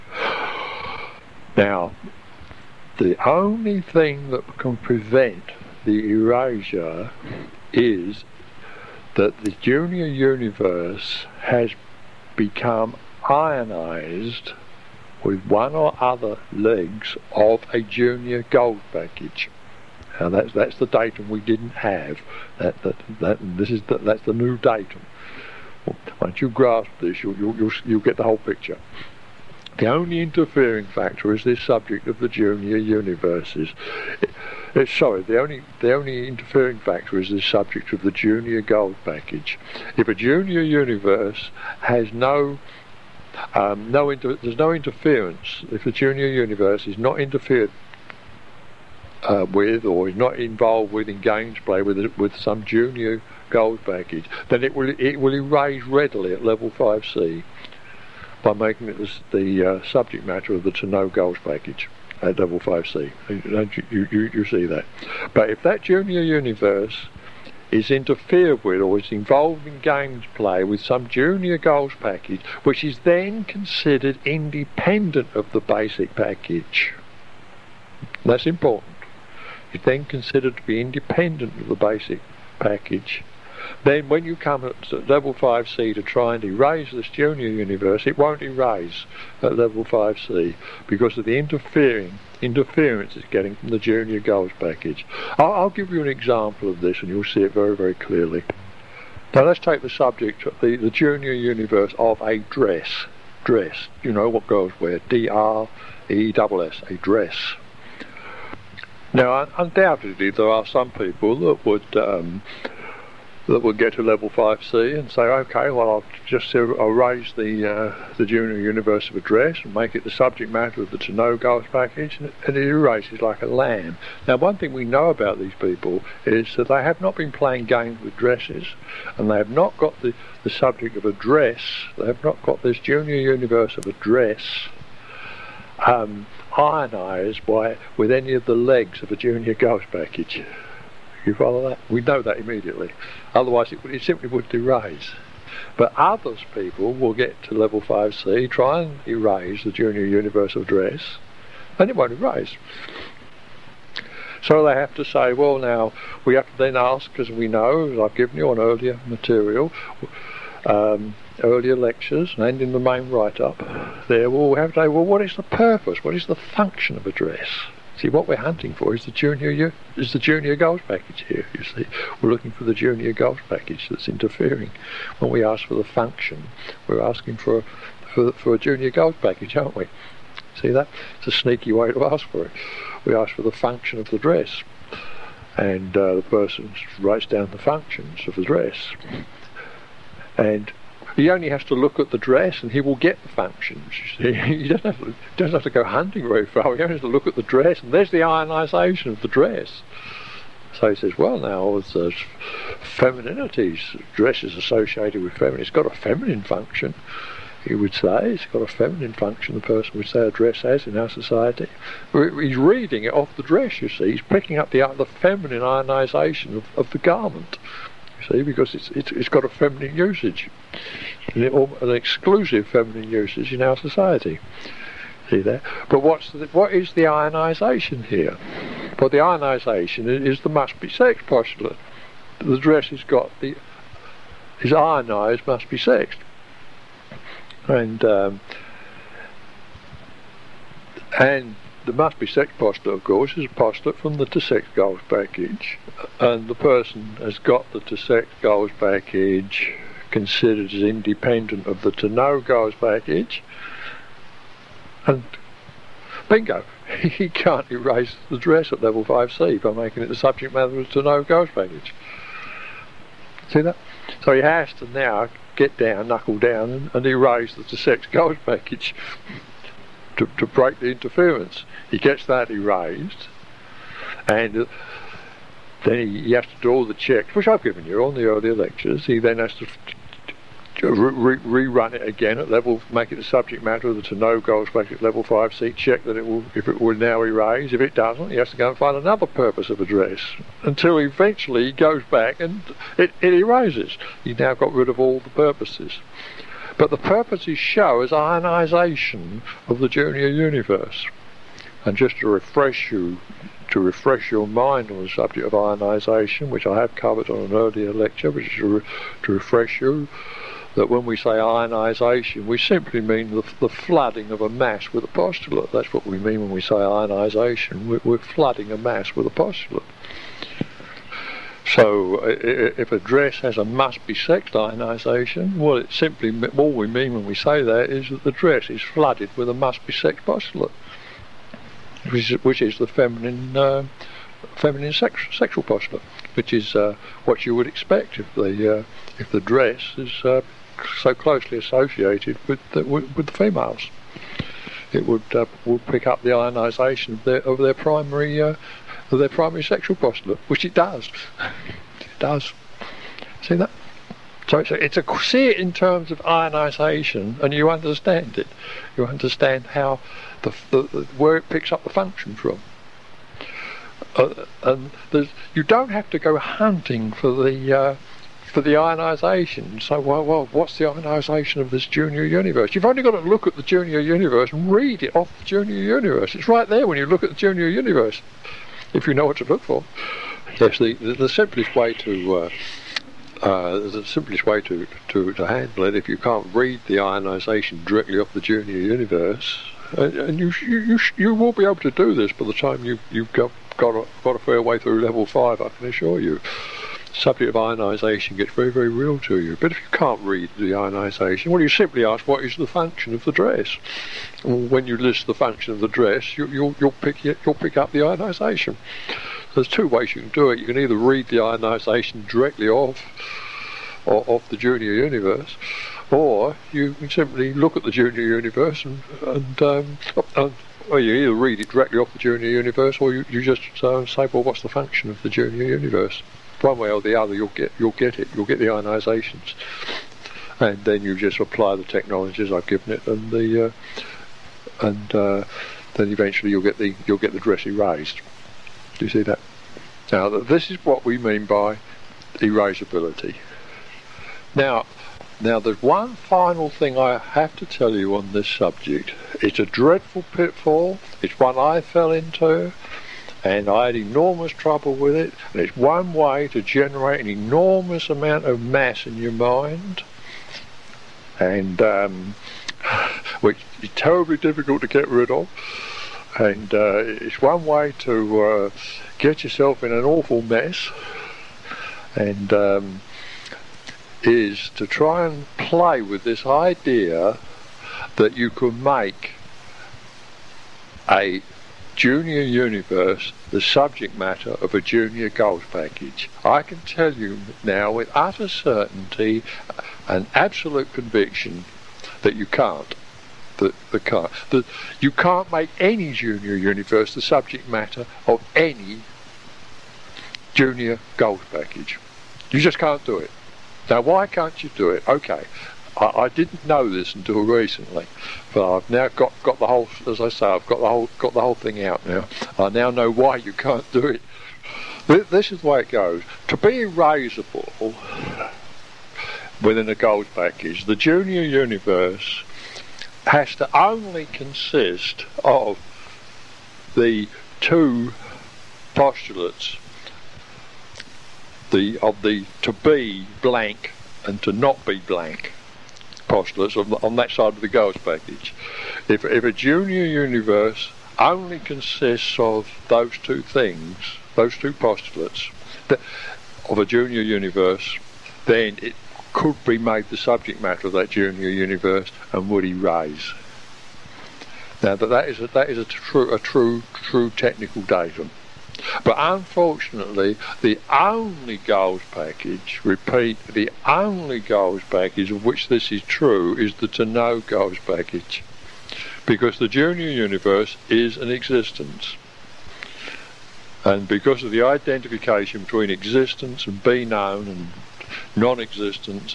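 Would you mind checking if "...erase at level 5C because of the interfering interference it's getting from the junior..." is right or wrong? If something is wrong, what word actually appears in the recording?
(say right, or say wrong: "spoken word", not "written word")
right.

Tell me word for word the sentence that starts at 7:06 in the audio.
one way or the other, you'll get you'll get it.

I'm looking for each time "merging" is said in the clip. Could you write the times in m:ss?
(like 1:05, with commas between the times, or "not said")
not said.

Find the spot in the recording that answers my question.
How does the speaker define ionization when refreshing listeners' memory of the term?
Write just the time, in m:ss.
5:13.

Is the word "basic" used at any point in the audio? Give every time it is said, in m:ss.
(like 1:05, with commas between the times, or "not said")
1:15, 1:21.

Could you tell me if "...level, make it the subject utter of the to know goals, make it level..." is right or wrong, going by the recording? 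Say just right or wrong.
wrong.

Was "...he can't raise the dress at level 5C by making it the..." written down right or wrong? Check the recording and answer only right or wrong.
wrong.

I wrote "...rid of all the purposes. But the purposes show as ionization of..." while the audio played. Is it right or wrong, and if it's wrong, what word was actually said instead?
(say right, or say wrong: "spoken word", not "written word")
right.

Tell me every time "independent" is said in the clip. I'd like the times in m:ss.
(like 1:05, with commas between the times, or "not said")
1:14, 1:20, 4:10.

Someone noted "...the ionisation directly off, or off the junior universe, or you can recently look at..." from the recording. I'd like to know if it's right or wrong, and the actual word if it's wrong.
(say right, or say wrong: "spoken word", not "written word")
wrong: "simply", not "recently".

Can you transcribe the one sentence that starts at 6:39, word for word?
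But if you can't read the ionisation, well, you simply ask, what is the function of the dress?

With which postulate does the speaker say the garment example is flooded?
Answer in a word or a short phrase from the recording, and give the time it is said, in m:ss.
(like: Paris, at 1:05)
Must be sexed, at 3:55.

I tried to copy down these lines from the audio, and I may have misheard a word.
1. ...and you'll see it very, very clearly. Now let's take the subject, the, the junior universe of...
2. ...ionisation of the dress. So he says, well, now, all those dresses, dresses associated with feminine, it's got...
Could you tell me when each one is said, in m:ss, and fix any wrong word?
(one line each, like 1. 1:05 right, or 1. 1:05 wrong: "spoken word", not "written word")
1. 1:37 right
2. 3:18 wrong: "femininities", not "dresses".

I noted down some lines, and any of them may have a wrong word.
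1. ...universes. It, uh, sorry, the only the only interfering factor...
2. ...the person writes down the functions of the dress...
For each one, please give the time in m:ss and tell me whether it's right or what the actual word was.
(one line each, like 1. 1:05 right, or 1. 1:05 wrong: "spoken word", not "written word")
1. 0:32 right
2. 3:06 right.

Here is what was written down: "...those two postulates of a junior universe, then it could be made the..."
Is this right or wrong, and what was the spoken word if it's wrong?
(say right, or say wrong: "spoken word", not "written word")
right.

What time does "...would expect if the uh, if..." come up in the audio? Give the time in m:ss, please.
5:37.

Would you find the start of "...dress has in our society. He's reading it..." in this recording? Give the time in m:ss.
3:30.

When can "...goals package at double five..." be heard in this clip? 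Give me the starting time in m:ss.
1:01.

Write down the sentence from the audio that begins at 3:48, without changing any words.
Well, the ionisation is the must be sex postulate.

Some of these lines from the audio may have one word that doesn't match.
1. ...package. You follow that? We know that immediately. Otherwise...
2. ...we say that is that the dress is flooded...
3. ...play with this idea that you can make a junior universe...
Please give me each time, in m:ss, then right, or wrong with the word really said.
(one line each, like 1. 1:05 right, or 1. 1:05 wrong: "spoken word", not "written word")
1. 2:19 right
2. 5:27 right
3. 7:55 right.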